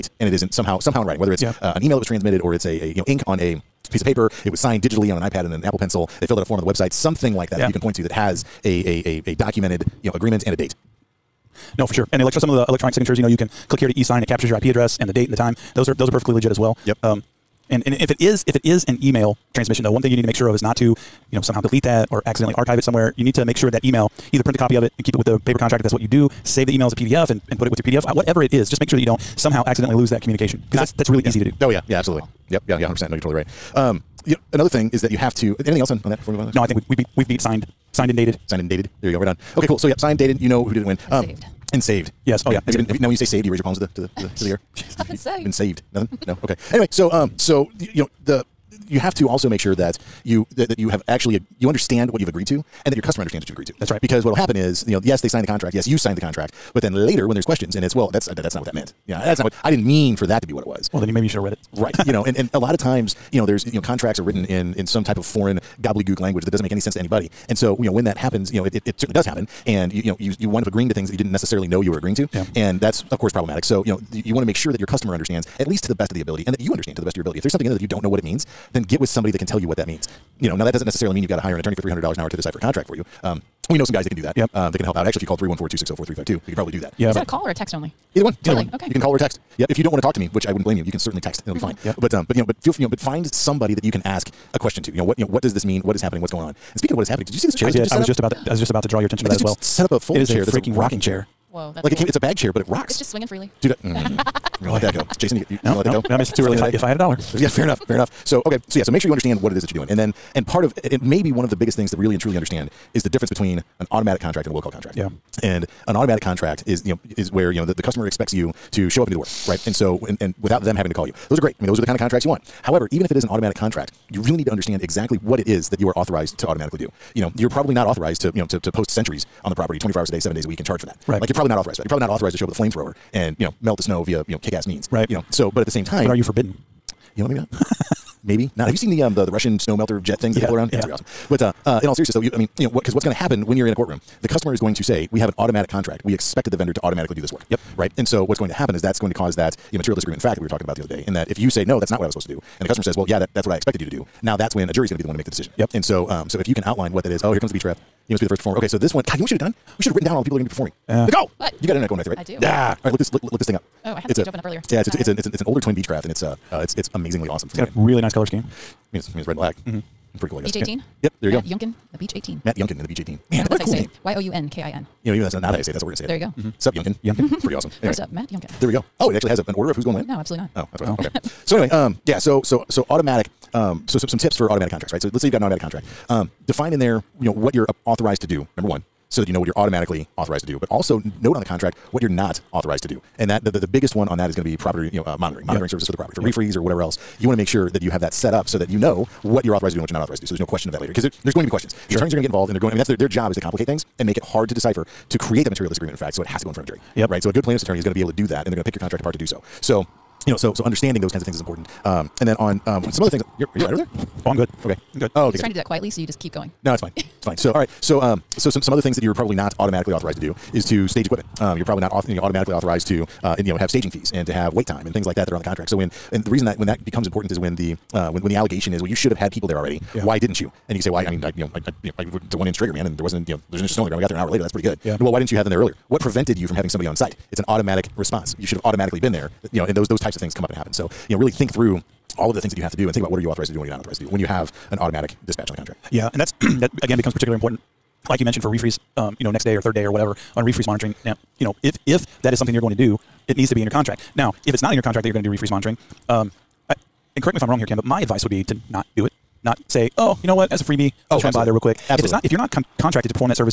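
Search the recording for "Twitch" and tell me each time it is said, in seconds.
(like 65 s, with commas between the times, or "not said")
not said.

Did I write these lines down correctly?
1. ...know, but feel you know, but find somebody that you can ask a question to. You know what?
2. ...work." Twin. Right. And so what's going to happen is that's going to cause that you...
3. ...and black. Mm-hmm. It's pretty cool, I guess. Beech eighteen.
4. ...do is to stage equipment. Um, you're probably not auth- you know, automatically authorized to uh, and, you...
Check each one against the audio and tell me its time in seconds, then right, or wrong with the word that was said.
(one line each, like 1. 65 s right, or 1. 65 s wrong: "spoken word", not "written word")
1. 92 s right
2. 147 s wrong: "Yep", not "Twin"
3. 169 s right
4. 220 s right.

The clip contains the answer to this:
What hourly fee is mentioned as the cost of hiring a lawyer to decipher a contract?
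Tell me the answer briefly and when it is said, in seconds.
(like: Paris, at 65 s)
$300, at 81 s.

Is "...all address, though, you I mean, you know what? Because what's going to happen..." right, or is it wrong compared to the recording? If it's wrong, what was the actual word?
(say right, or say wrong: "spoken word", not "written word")
wrong: "seriousness", not "address".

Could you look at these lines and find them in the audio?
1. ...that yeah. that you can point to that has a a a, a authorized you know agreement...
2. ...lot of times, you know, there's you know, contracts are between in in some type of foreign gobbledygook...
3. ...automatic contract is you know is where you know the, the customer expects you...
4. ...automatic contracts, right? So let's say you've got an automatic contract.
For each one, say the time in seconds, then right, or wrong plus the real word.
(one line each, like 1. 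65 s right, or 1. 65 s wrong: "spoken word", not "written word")
1. 7 s wrong: "documented", not "authorized"
2. 62 s wrong: "written", not "between"
3. 115 s right
4. 184 s right.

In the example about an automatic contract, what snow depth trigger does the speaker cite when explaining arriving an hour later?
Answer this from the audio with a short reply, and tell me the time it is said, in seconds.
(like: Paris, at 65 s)
1 inch, at 232 s.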